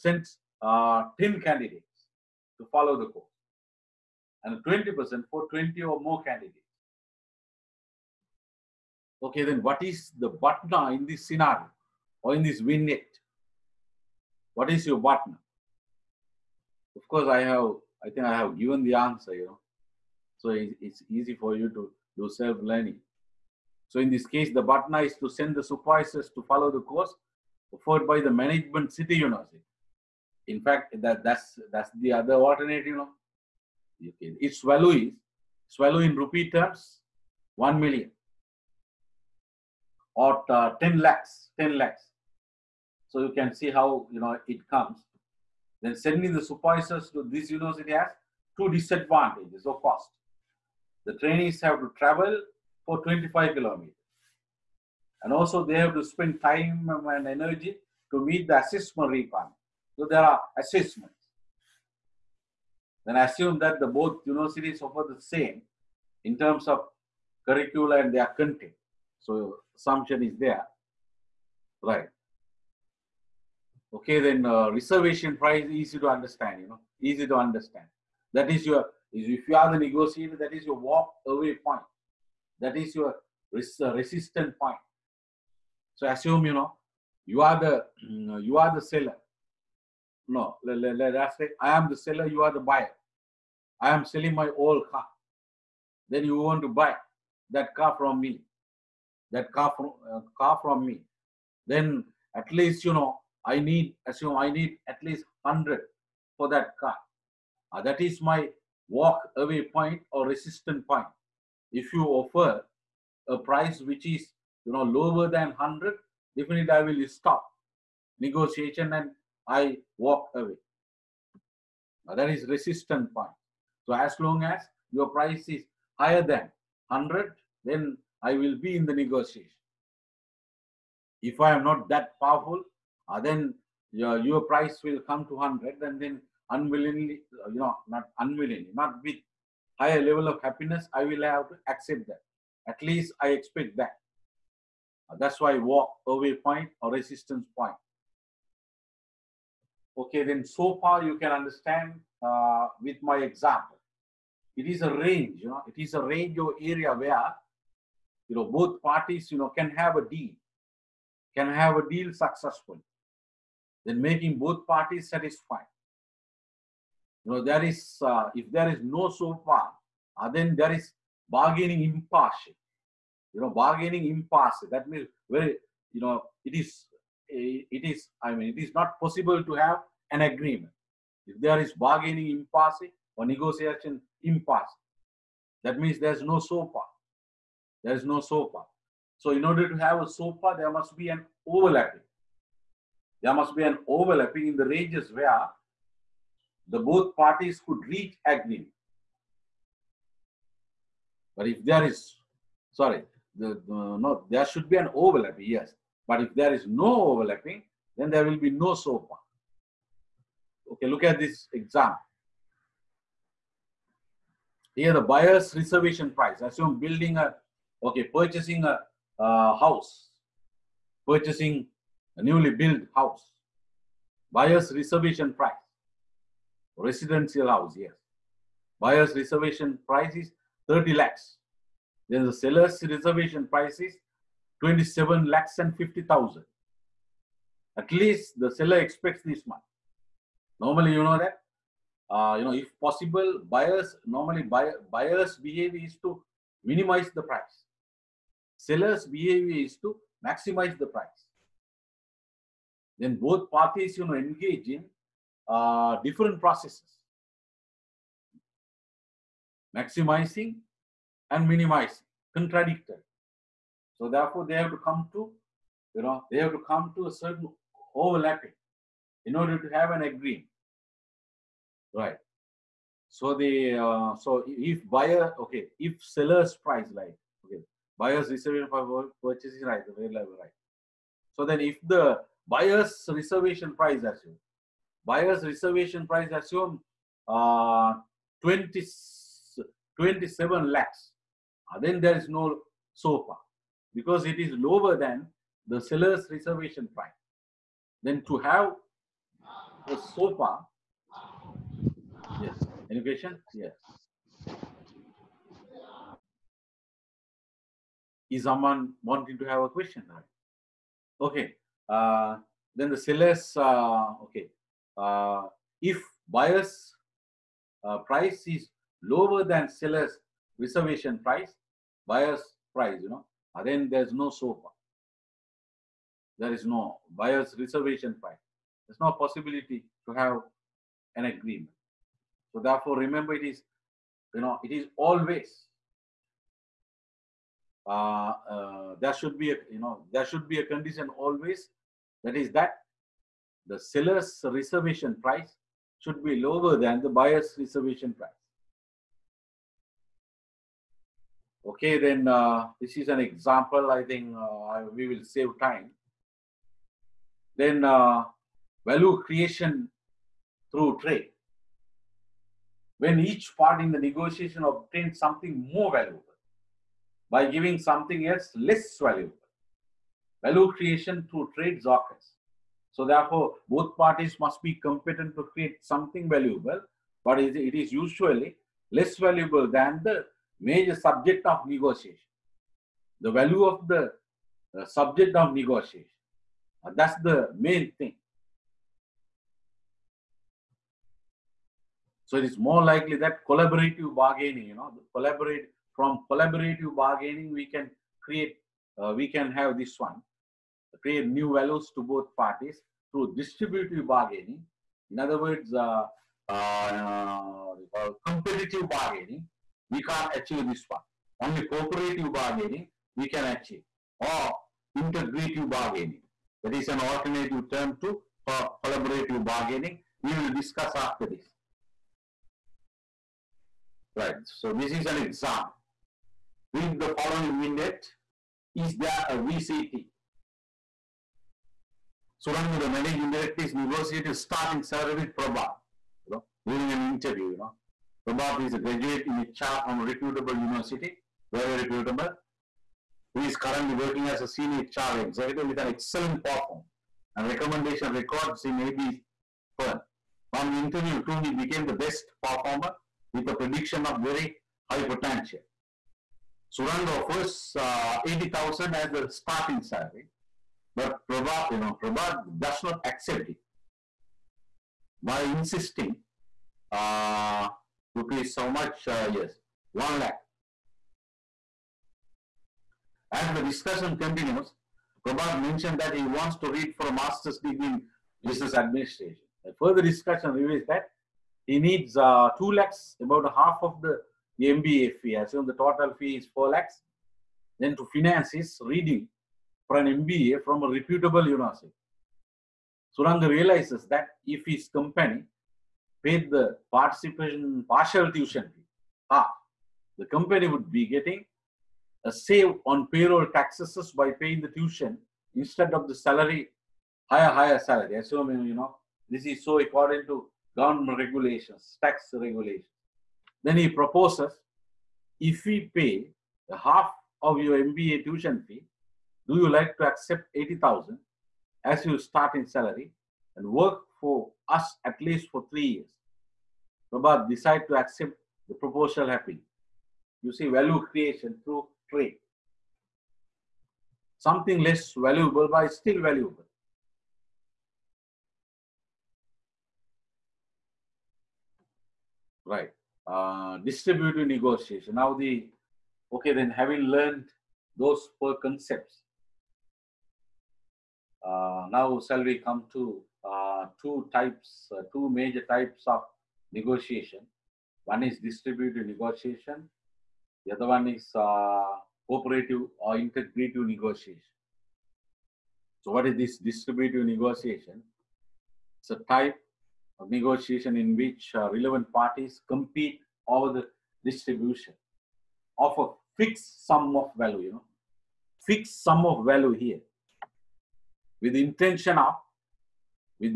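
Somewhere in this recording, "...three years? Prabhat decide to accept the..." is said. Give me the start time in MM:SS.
08:45.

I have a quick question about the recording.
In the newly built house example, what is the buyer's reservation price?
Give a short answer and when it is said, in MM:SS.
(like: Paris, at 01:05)
30 lakhs, at 03:50.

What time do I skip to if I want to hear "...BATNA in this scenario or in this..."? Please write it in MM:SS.
00:10.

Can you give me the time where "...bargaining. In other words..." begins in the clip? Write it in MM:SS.
06:44.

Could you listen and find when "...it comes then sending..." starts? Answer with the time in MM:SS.
00:44.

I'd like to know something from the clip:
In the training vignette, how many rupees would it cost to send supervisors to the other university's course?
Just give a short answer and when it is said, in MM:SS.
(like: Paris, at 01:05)
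10 lakhs, at 00:40.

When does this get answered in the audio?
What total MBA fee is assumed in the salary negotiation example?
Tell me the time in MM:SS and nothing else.
08:06.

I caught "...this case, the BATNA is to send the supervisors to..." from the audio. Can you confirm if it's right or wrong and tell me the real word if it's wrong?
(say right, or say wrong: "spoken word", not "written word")
right.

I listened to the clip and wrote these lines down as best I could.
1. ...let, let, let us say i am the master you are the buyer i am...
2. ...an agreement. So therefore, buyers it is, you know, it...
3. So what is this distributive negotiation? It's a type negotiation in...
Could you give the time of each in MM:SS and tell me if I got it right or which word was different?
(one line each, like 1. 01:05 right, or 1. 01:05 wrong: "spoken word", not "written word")
1. 01:30 wrong: "seller", not "master"
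2. 05:31 wrong: "remember", not "buyers"
3. 09:26 right.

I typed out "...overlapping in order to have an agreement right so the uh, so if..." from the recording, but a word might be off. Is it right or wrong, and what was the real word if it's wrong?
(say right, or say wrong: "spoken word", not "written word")
right.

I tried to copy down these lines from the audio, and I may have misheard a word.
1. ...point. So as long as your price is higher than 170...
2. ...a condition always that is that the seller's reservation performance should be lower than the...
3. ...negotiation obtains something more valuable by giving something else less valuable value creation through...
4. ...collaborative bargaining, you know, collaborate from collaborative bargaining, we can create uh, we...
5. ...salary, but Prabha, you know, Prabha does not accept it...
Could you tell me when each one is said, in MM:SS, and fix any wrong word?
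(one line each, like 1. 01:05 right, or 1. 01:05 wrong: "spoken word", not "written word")
1. 02:03 wrong: "100", not "170"
2. 05:40 wrong: "price", not "performance"
3. 06:03 right
4. 06:33 right
5. 07:39 right.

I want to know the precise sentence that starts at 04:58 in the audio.
Then to have a ZOPA, yes, any question?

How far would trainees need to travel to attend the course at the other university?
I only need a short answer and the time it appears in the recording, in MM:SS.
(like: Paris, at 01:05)
25 kilometers, at 00:53.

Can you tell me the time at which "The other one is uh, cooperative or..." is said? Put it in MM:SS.
09:20.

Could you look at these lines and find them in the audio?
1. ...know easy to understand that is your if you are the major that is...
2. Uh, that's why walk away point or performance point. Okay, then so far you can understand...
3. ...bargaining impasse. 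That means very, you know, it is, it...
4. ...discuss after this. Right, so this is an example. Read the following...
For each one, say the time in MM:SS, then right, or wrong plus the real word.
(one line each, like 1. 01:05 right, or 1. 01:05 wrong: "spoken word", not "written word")
1. 01:16 wrong: "negotiator", not "major"
2. 02:25 wrong: "resistance", not "performance"
3. 02:53 right
4. 07:00 right.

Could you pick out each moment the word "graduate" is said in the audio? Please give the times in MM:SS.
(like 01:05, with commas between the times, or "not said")
07:18.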